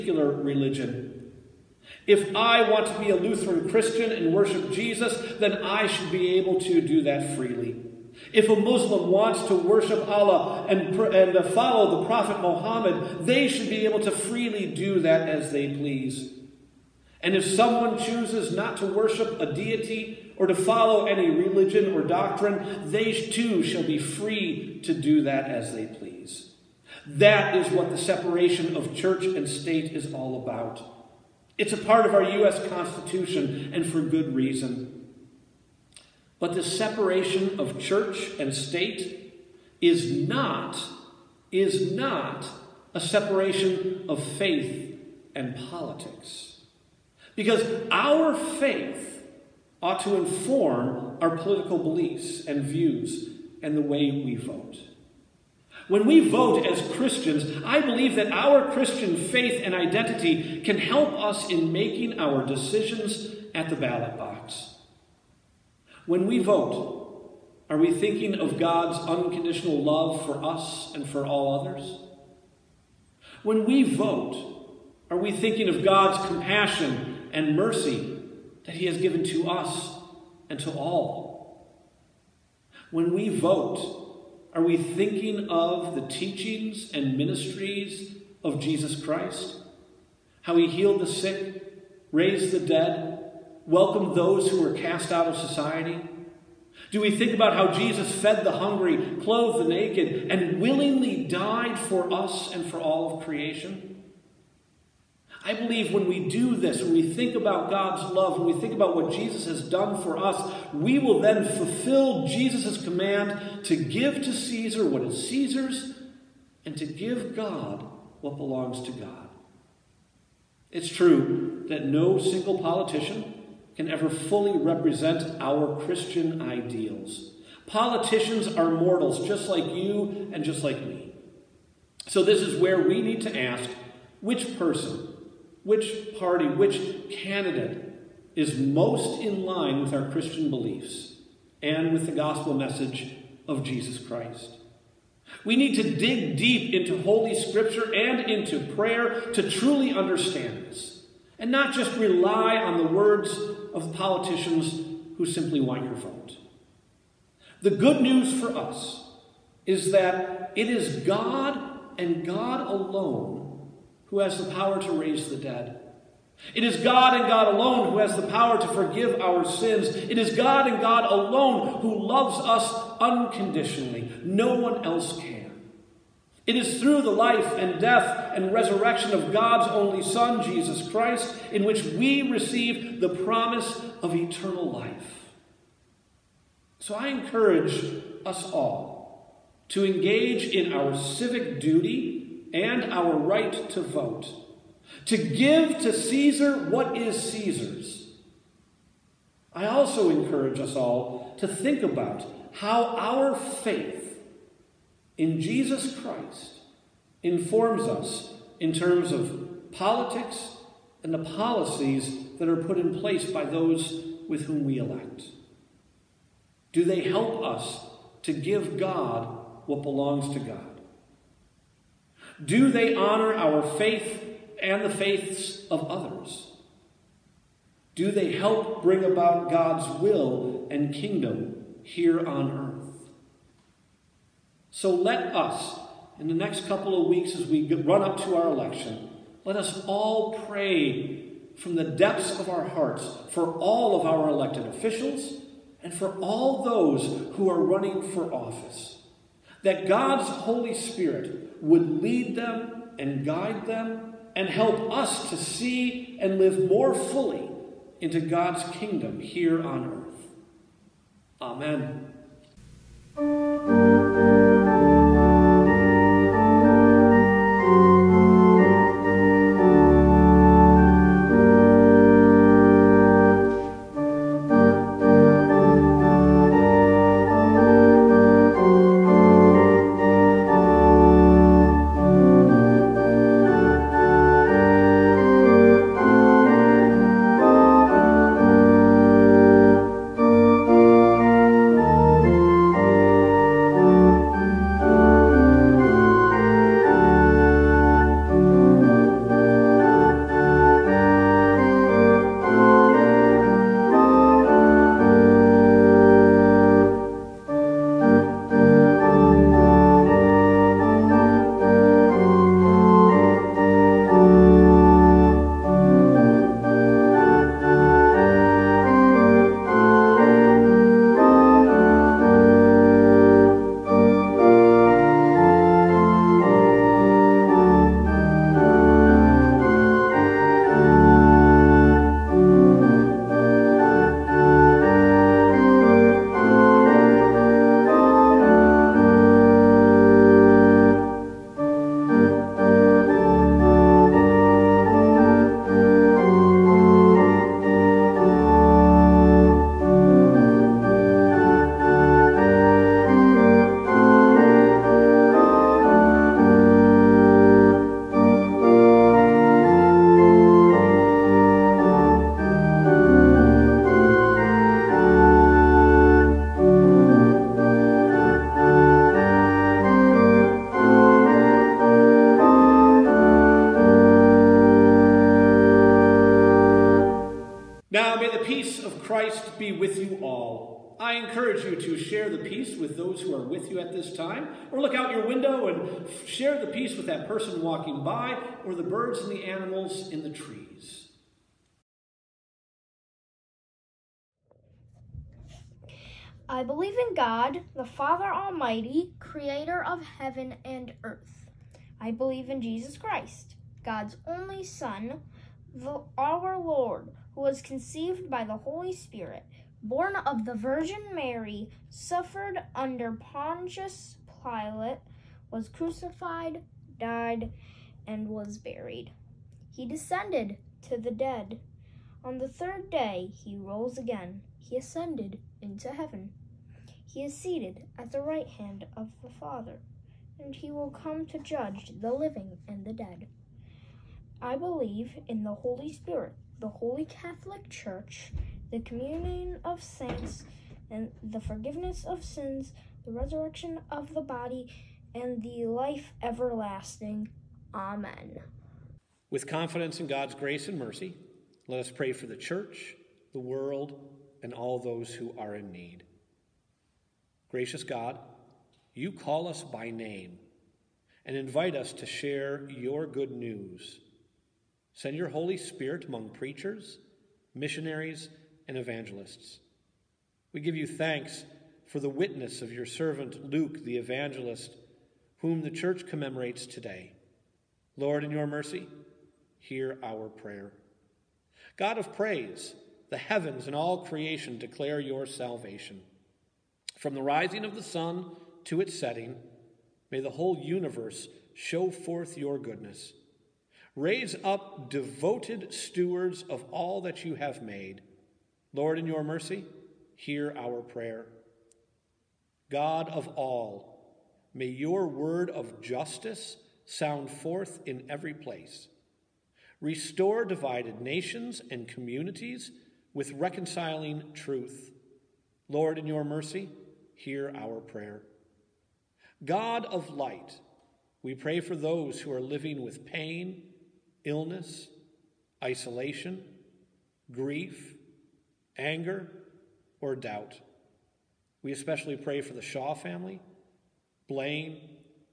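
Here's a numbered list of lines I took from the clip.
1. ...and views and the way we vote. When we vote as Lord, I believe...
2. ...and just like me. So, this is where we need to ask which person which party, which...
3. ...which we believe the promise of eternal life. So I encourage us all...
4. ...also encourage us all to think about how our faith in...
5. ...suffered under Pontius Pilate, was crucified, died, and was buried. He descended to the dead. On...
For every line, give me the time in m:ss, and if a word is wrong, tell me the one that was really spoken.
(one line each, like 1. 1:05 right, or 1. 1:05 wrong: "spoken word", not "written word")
1. 0:52 wrong: "Christians", not "Lord"
2. 2:10 right
3. 3:01 wrong: "receive", not "believe"
4. 3:19 right
5. 6:51 right.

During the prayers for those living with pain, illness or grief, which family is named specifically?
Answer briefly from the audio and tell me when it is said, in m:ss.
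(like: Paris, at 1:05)
Shaw family, at 8:52.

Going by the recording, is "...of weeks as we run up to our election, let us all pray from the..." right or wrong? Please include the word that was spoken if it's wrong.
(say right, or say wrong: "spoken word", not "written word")
right.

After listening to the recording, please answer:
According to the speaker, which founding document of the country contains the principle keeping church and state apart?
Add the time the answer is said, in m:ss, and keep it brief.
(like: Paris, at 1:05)
U.S. Constitution, at 0:32.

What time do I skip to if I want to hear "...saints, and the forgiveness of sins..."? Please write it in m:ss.
7:19.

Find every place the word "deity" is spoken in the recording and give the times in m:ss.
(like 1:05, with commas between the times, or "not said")
0:19.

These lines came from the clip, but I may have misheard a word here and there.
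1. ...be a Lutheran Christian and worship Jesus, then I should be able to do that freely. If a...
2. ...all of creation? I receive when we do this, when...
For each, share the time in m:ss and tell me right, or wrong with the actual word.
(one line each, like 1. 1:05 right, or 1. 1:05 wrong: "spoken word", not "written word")
1. 0:02 right
2. 1:42 wrong: "believe", not "receive".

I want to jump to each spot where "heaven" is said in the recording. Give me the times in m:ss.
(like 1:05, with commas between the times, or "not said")
6:40, 7:05, 8:03.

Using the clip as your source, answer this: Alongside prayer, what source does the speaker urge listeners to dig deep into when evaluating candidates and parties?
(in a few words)
Holy Scripture.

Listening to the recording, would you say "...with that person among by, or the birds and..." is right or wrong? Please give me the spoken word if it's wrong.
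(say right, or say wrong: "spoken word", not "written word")
wrong: "walking", not "among".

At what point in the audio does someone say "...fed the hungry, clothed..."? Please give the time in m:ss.
1:38.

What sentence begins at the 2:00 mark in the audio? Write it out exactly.
It's true that no single politician can ever fully represent our Christian ideals.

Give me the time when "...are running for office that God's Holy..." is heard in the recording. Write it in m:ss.
4:07.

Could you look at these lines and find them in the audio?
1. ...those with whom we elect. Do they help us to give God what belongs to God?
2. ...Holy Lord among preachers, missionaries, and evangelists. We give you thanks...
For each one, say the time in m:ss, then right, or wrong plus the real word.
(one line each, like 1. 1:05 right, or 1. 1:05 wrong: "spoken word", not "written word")
1. 3:33 right
2. 7:45 wrong: "Spirit", not "Lord".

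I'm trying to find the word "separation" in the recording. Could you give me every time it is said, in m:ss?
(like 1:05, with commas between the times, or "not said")
0:27, 0:36, 0:43.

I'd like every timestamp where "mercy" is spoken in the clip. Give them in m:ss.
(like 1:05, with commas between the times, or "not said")
1:17, 7:30, 7:58, 8:19, 8:36.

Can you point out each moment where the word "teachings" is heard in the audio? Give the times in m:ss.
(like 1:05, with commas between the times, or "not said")
1:26.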